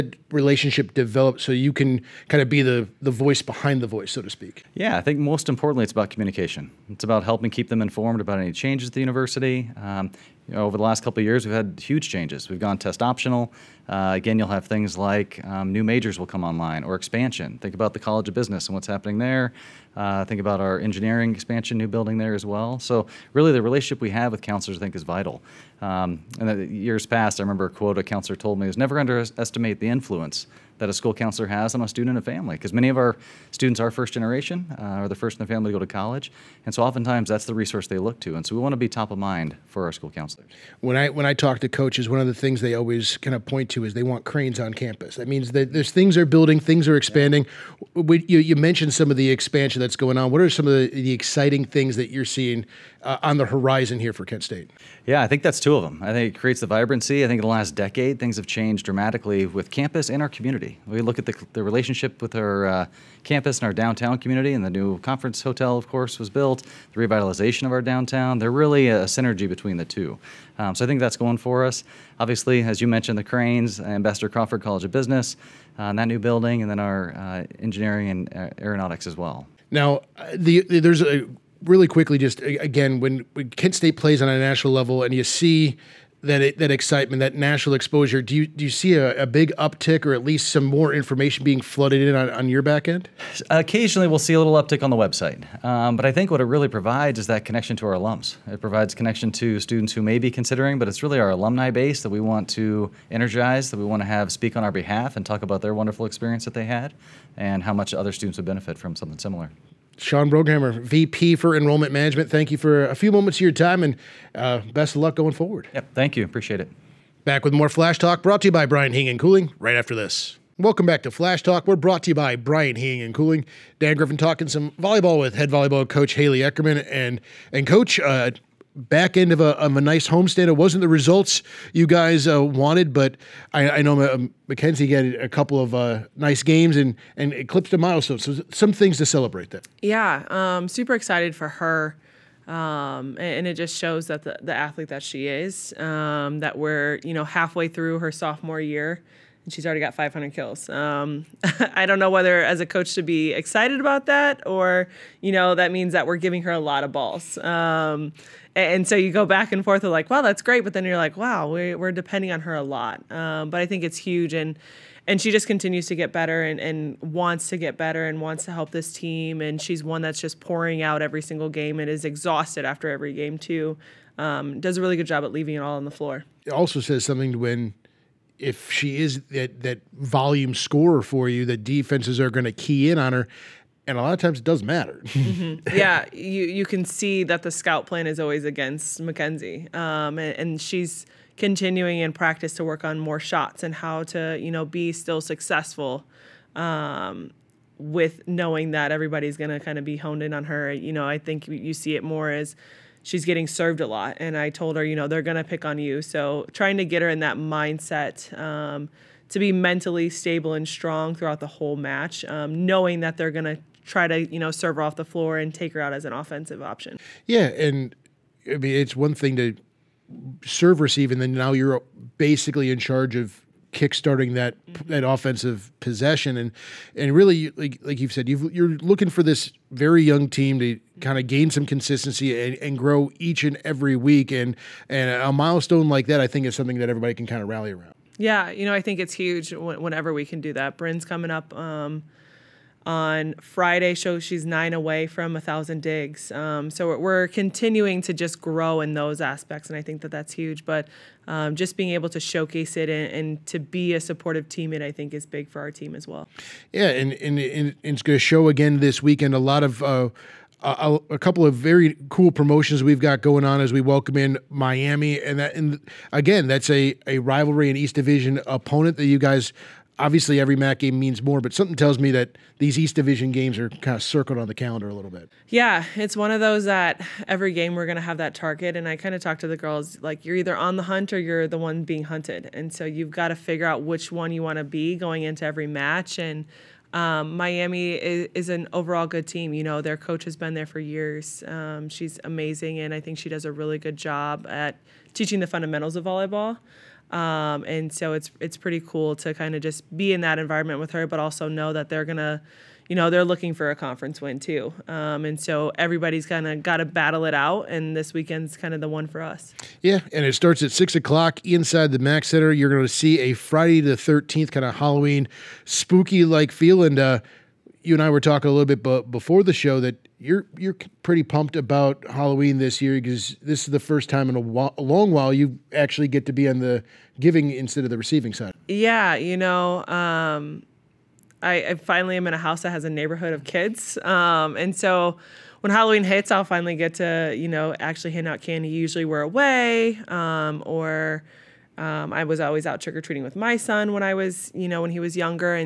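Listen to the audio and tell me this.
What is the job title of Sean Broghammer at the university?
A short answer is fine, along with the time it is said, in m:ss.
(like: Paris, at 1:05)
VP for Enrollment Management, at 1:50.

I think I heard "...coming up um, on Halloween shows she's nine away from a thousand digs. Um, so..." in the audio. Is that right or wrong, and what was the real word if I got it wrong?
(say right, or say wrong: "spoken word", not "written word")
wrong: "Friday", not "Halloween".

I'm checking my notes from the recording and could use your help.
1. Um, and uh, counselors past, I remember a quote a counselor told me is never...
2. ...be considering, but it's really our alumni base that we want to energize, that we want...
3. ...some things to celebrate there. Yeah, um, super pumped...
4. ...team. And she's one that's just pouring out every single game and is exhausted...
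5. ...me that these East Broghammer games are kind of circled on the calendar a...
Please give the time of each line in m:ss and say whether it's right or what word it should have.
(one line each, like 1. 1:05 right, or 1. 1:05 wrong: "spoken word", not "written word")
1. 0:25 wrong: "years", not "counselors"
2. 1:40 right
3. 2:18 wrong: "excited", not "pumped"
4. 2:48 right
5. 4:31 wrong: "Division", not "Broghammer".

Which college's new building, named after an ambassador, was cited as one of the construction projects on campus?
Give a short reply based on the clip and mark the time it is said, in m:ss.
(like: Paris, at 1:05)
Ambassador Crawford College of Business, at 1:13.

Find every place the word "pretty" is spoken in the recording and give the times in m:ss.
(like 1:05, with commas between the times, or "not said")
4:58, 5:21.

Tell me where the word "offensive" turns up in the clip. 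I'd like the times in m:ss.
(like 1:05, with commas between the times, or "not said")
3:36, 3:45.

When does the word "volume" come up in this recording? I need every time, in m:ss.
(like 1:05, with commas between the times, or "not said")
2:59.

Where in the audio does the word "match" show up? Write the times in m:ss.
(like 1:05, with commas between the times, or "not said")
3:31, 4:45.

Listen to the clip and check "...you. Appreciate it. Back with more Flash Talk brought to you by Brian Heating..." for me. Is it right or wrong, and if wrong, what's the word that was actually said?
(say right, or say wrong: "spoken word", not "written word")
right.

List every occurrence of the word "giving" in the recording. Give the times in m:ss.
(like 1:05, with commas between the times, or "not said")
2:36, 5:27.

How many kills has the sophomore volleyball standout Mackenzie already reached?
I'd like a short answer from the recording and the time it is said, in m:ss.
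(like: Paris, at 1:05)
500, at 2:29.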